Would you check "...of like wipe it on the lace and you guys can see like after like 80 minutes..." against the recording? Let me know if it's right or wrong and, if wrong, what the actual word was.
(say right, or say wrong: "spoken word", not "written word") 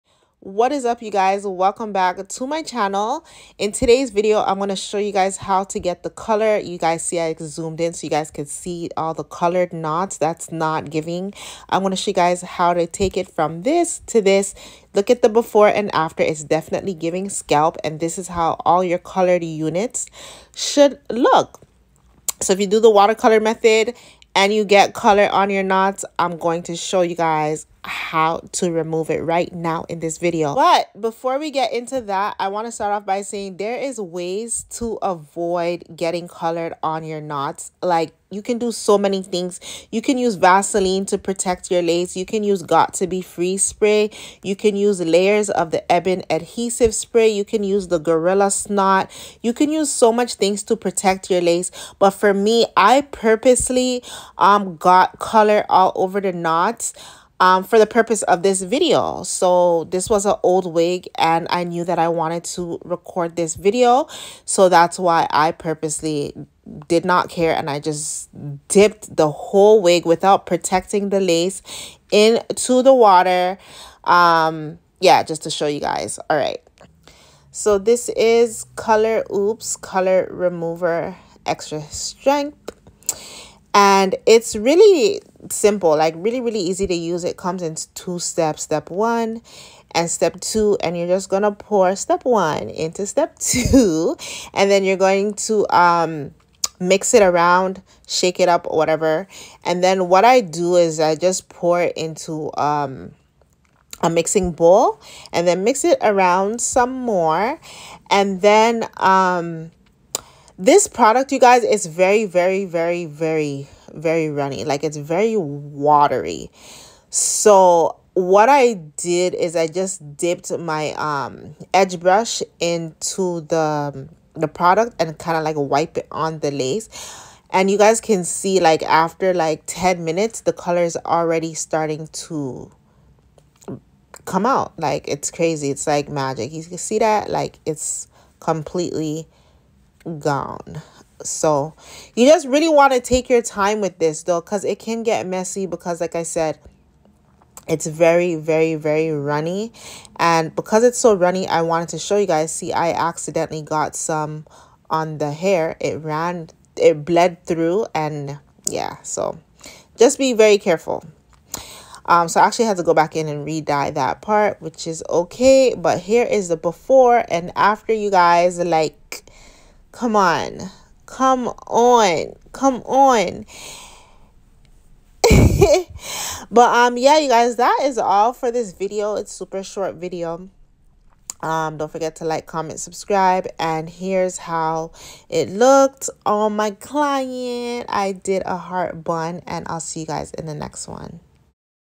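wrong: "10", not "80".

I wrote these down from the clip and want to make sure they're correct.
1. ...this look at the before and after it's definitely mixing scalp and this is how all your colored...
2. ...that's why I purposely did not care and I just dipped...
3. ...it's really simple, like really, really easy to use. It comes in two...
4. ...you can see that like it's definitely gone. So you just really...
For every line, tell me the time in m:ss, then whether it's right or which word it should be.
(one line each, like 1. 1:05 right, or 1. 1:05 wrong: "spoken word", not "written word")
1. 0:14 wrong: "giving", not "mixing"
2. 1:04 right
3. 1:24 right
4. 2:16 wrong: "completely", not "definitely".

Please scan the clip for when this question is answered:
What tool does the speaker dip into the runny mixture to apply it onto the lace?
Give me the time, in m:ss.
2:01.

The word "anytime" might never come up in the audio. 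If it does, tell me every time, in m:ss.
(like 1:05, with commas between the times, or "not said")
not said.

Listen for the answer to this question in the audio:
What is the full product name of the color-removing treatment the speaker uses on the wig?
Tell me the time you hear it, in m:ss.
1:18.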